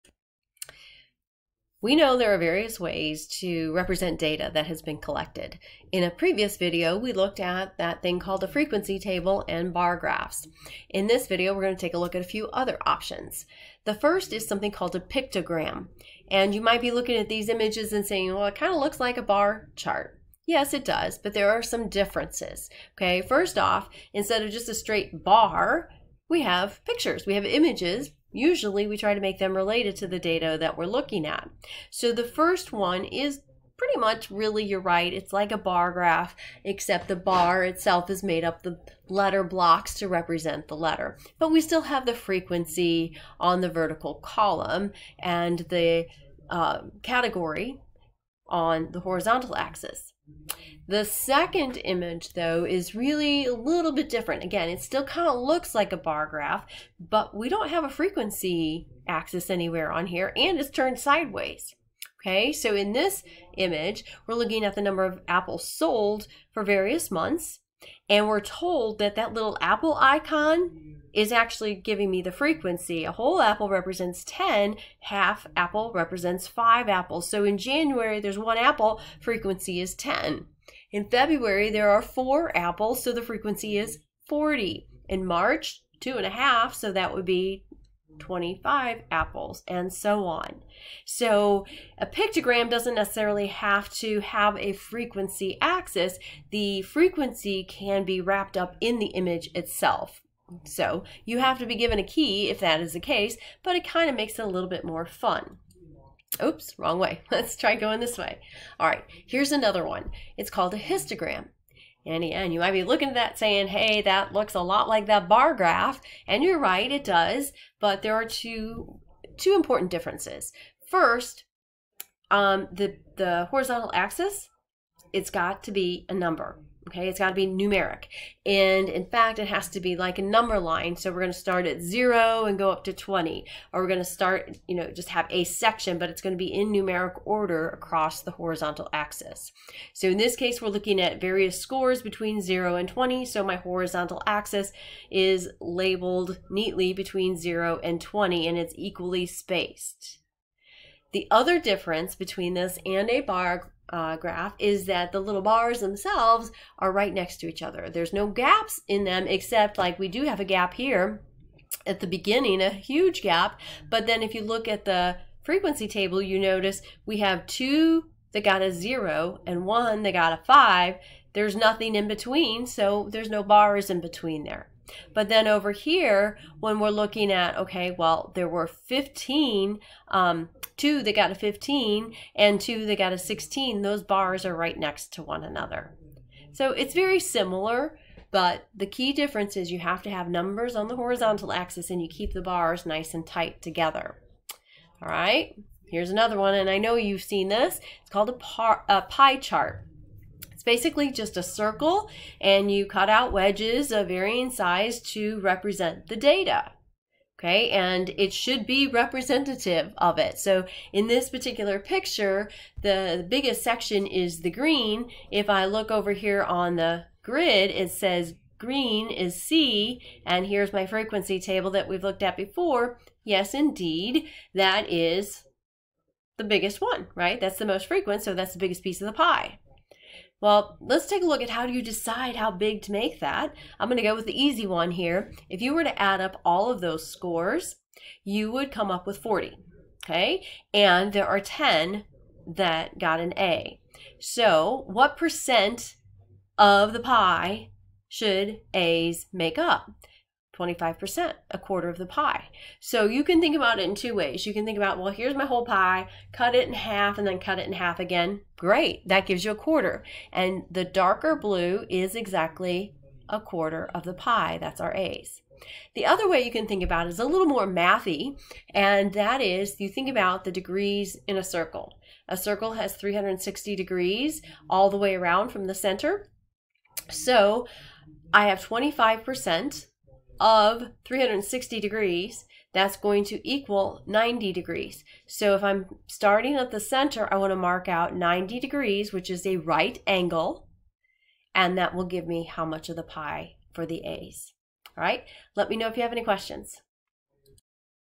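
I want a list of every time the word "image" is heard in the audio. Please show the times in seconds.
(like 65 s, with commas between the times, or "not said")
17 s, 27 s, 51 s, 63 s, 99 s.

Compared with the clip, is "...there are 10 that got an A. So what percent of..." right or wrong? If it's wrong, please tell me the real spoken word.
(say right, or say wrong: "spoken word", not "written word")
right.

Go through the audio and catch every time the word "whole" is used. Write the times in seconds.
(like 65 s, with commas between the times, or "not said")
73 s, 255 s.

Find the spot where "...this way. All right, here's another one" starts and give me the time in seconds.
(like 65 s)
107 s.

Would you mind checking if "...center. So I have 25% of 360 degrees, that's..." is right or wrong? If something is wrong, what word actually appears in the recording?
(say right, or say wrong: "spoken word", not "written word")
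right.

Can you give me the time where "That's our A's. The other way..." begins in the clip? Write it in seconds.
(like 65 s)
264 s.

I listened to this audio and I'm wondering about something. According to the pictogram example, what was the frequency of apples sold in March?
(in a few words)
25.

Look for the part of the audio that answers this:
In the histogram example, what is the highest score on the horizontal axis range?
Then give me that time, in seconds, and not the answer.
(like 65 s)
132 s.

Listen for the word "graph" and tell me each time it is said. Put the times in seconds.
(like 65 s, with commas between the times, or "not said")
9 s, 35 s, 56 s, 115 s, 154 s.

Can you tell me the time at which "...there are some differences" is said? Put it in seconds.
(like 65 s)
21 s.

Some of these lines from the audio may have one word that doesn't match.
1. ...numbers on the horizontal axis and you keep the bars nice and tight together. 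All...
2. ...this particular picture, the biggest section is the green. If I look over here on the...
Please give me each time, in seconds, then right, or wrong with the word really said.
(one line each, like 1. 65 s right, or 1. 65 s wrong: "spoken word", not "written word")
1. 190 s right
2. 211 s right.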